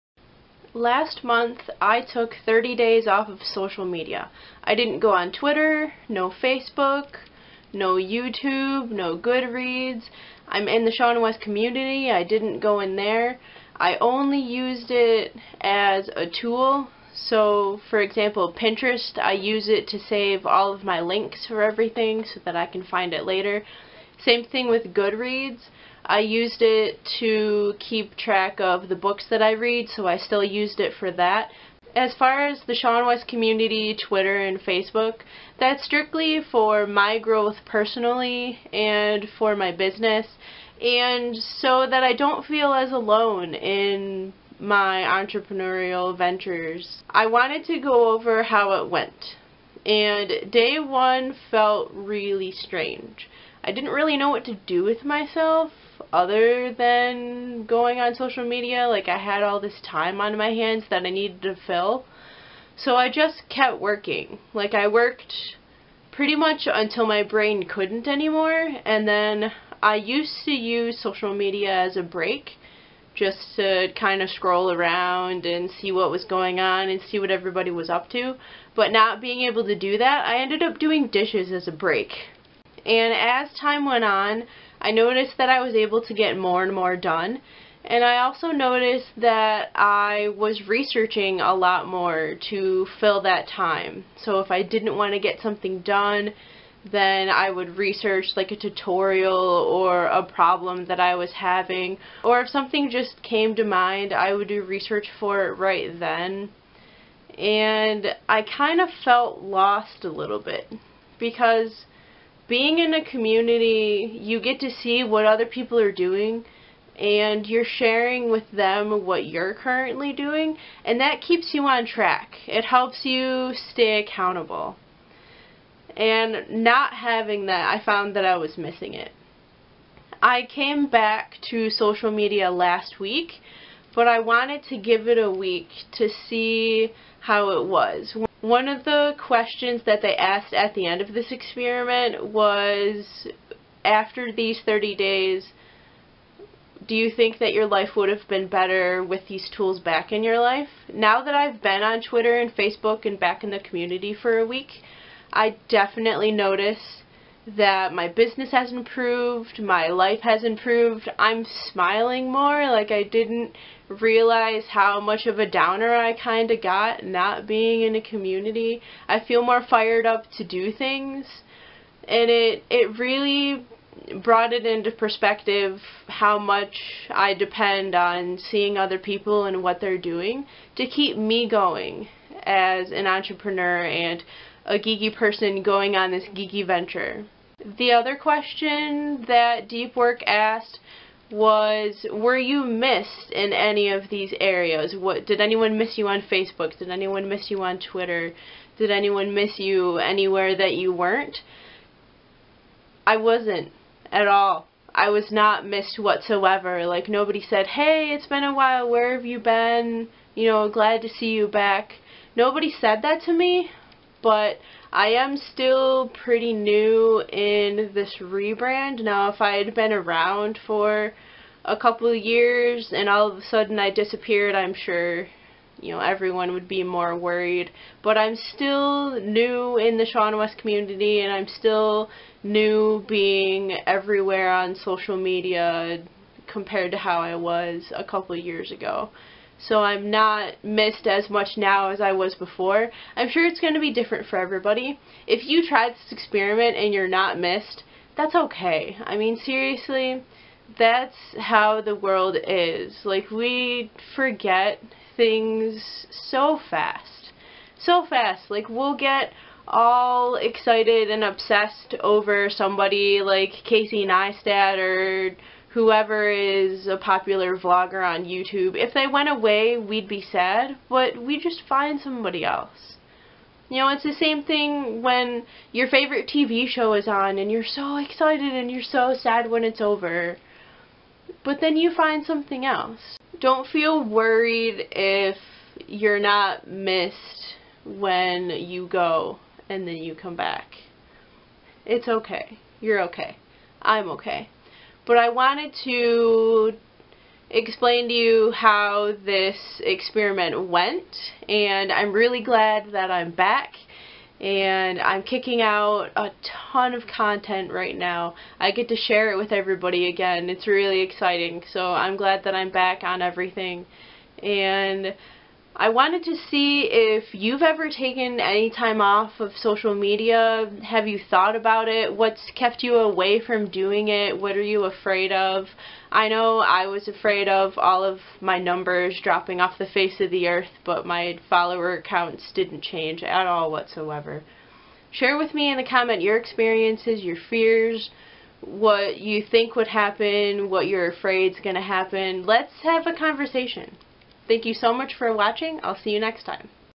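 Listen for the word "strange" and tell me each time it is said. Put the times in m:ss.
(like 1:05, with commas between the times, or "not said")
0:52.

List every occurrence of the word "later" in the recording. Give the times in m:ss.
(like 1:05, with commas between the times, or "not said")
0:23.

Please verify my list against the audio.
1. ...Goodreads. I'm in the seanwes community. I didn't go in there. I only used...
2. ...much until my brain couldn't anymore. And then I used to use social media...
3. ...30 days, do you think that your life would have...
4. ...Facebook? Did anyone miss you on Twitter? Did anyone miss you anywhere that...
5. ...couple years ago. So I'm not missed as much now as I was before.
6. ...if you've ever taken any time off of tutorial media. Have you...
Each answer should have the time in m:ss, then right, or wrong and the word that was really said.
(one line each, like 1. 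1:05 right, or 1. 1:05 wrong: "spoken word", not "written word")
1. 0:09 right
2. 1:06 right
3. 2:24 right
4. 3:16 right
5. 3:58 right
6. 5:16 wrong: "social", not "tutorial".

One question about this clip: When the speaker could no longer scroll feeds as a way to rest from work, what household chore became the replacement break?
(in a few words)
Doing dishes.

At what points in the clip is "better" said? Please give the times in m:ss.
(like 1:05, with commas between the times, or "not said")
2:28.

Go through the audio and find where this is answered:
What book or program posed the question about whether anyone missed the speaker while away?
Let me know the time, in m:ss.
3:09.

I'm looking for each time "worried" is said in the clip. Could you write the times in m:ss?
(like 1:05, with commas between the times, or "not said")
3:47, 4:44.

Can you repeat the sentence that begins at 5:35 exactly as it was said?
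Share with me in the comment your experiences, your fears, what you think would happen, what you're afraid is going to happen.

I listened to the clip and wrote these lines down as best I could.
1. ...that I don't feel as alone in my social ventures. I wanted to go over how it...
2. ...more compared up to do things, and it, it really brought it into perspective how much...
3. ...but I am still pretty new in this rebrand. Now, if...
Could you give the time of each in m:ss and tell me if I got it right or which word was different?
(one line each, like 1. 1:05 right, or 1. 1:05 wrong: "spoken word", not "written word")
1. 0:41 wrong: "entrepreneurial", not "social"
2. 2:49 wrong: "fired", not "compared"
3. 3:34 right.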